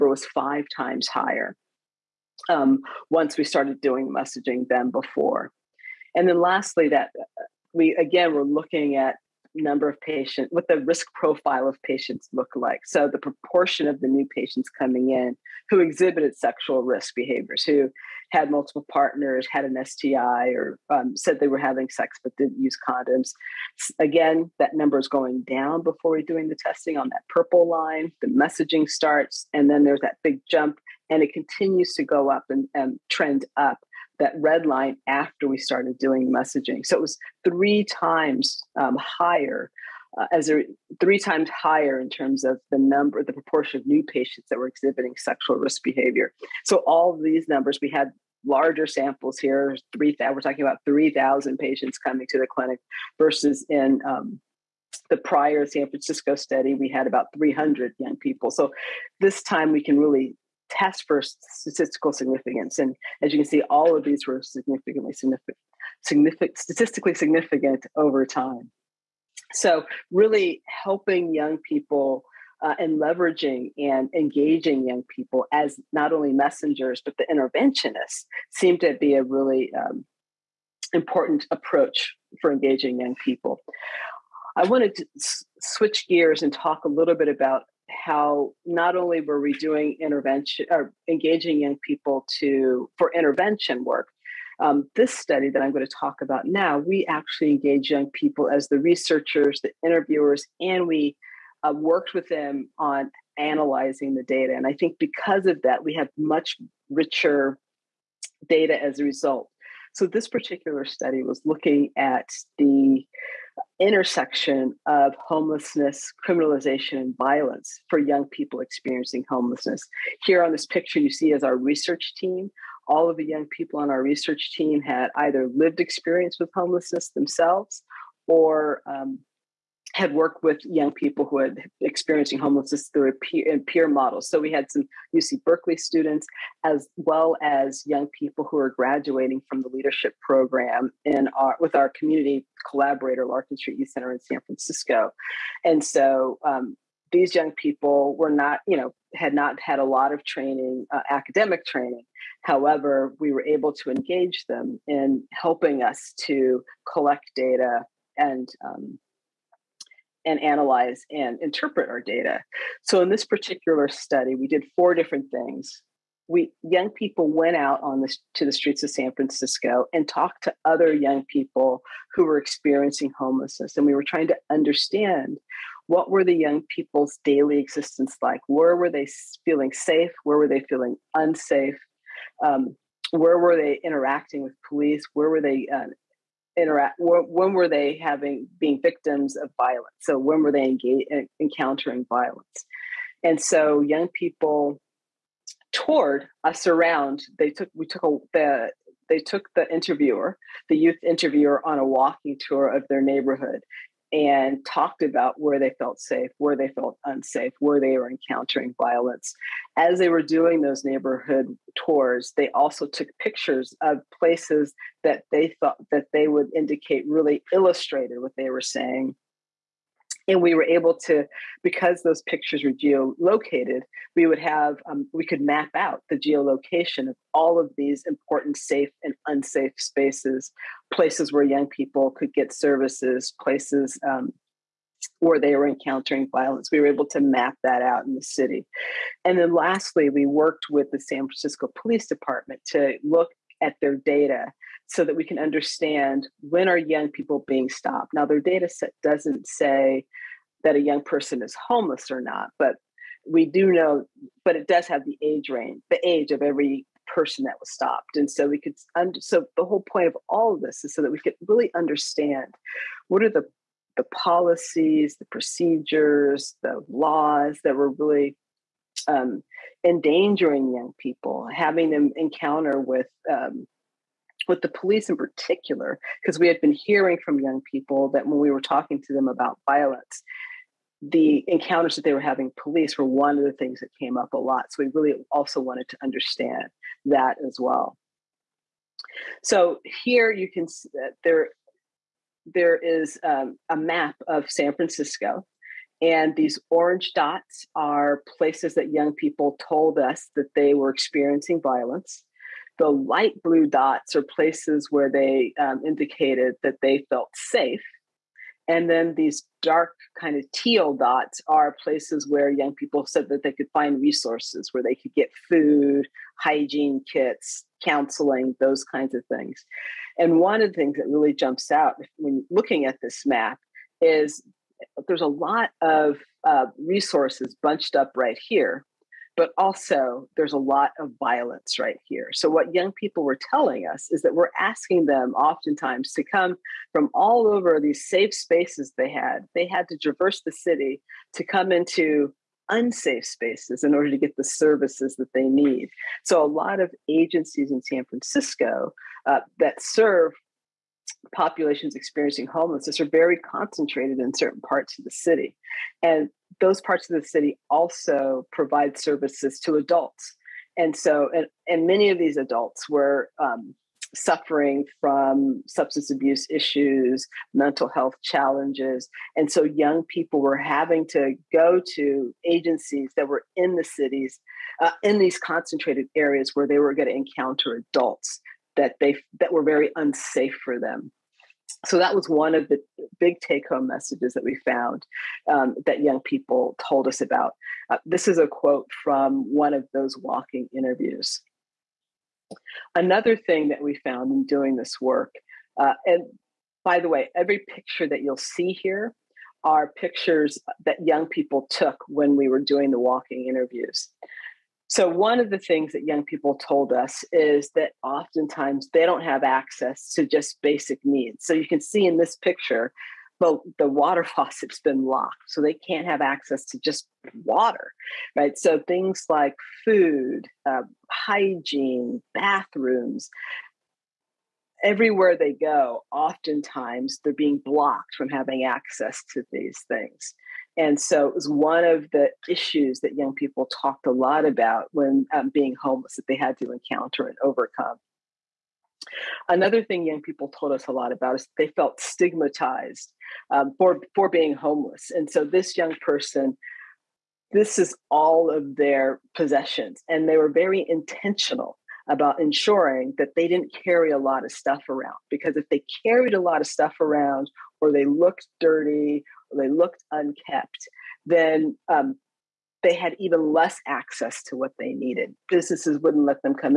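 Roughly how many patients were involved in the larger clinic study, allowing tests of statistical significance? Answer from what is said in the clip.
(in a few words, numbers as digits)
3,000.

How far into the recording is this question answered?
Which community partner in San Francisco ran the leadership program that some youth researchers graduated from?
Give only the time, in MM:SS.
02:23.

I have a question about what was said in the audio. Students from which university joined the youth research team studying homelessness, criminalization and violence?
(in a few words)
UC Berkeley.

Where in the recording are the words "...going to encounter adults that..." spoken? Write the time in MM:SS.
06:16.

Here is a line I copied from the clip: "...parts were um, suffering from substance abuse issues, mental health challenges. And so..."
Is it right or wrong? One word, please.
wrong.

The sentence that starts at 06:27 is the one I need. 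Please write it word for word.
Uh, this is a quote from one of those walking interviews.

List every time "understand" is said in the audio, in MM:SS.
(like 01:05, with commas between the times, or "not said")
02:54, 04:05, 04:21, 04:46.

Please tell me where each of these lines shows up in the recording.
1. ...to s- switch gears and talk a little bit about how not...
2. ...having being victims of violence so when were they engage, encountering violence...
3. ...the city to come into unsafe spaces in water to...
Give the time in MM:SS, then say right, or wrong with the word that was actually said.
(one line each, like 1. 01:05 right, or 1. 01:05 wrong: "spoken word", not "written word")
1. 01:24 right
2. 03:07 right
3. 05:40 wrong: "order", not "water".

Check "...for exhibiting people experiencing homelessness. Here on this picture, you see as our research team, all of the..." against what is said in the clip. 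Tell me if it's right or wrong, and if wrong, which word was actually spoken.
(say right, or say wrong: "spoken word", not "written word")
wrong: "young", not "exhibiting".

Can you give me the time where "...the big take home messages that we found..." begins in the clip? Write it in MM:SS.
06:22.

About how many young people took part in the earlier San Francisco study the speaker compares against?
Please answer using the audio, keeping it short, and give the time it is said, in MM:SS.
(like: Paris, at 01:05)
300, at 00:57.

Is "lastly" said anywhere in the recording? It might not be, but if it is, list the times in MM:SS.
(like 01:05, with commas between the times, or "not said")
00:06, 03:59.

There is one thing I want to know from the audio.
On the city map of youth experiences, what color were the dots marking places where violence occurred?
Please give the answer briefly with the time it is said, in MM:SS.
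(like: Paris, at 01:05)
orange, at 04:56.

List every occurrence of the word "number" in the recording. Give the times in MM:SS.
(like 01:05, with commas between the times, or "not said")
00:09, 00:24, 00:42, 00:47.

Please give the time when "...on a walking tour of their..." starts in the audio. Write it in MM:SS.
03:21.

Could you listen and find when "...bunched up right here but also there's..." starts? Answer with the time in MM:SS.
05:27.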